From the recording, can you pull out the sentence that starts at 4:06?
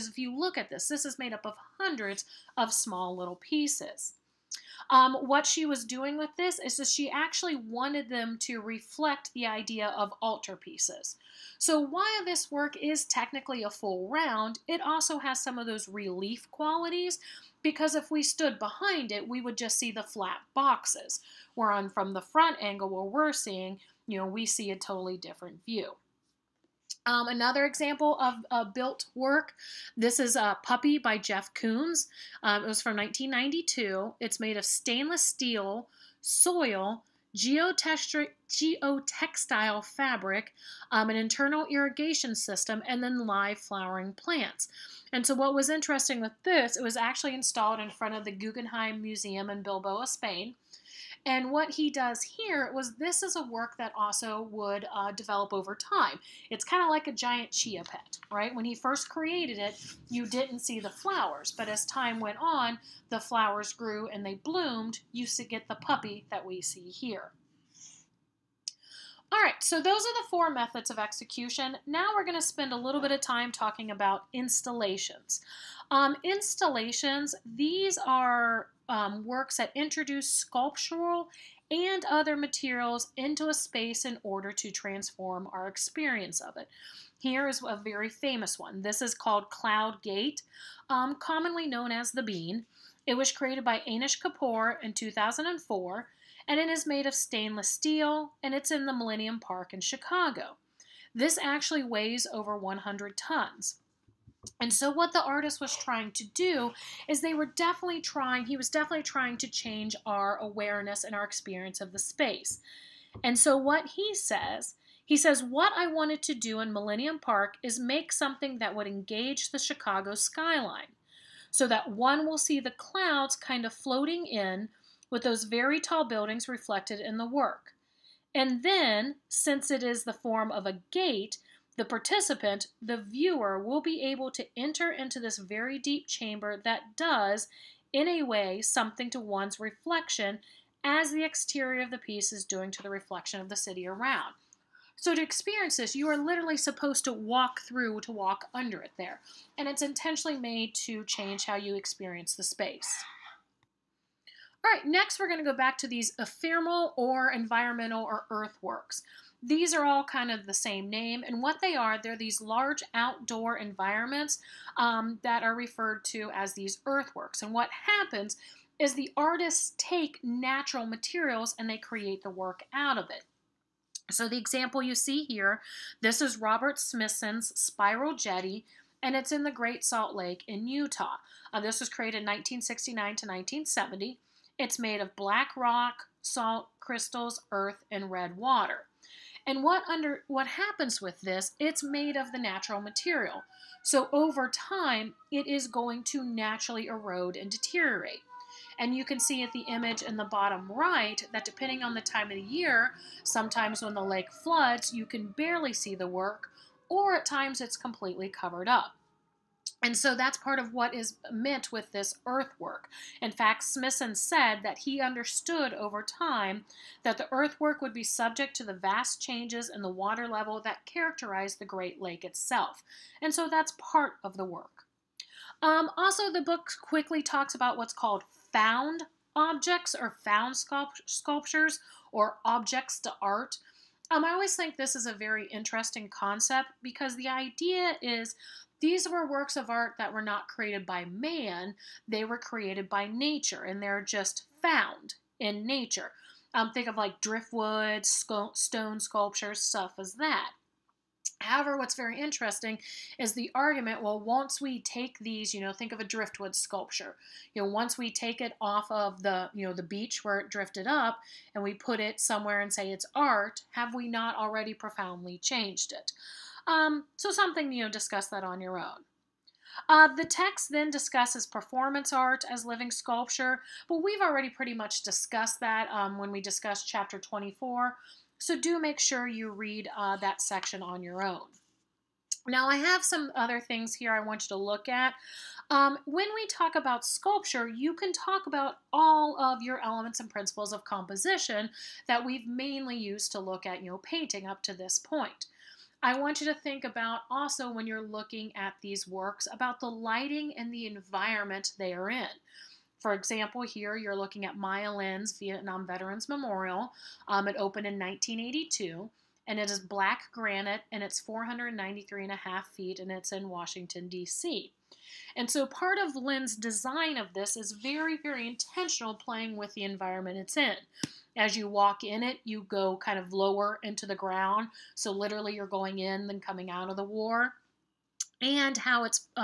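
Um, think of like driftwood, sco- stone sculptures, stuff as that.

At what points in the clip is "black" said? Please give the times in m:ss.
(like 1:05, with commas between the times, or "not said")
3:05, 5:09.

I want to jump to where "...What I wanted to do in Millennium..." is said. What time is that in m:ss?
1:55.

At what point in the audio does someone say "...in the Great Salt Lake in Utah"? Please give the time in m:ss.
2:59.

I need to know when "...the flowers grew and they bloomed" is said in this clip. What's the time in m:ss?
1:03.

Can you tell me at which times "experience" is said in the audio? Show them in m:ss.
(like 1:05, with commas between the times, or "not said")
1:25, 1:51, 2:25, 2:31.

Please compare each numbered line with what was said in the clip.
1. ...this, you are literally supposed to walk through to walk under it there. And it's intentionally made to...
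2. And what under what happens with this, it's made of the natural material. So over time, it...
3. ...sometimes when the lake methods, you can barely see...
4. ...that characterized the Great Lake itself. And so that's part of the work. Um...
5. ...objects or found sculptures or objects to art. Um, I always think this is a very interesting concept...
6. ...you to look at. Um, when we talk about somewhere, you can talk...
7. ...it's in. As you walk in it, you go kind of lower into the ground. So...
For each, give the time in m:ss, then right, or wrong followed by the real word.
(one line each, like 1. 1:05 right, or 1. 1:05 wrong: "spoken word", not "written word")
1. 2:25 right
2. 3:09 right
3. 3:23 wrong: "floods", not "methods"
4. 3:40 right
5. 3:49 right
6. 4:44 wrong: "sculpture", not "somewhere"
7. 5:20 right.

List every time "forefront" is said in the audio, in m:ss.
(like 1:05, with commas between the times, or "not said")
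not said.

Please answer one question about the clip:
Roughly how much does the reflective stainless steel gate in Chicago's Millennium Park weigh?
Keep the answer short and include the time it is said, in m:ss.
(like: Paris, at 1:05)
Over 100 tons, at 1:42.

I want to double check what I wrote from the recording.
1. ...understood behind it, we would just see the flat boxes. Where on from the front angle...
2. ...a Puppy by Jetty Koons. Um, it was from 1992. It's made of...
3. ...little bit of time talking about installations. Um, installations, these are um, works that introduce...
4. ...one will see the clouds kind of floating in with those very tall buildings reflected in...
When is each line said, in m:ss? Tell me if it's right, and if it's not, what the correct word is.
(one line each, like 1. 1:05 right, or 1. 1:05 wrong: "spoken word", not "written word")
1. 0:18 wrong: "stood", not "understood"
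2. 0:30 wrong: "Jeff", not "Jetty"
3. 1:12 right
4. 2:01 right.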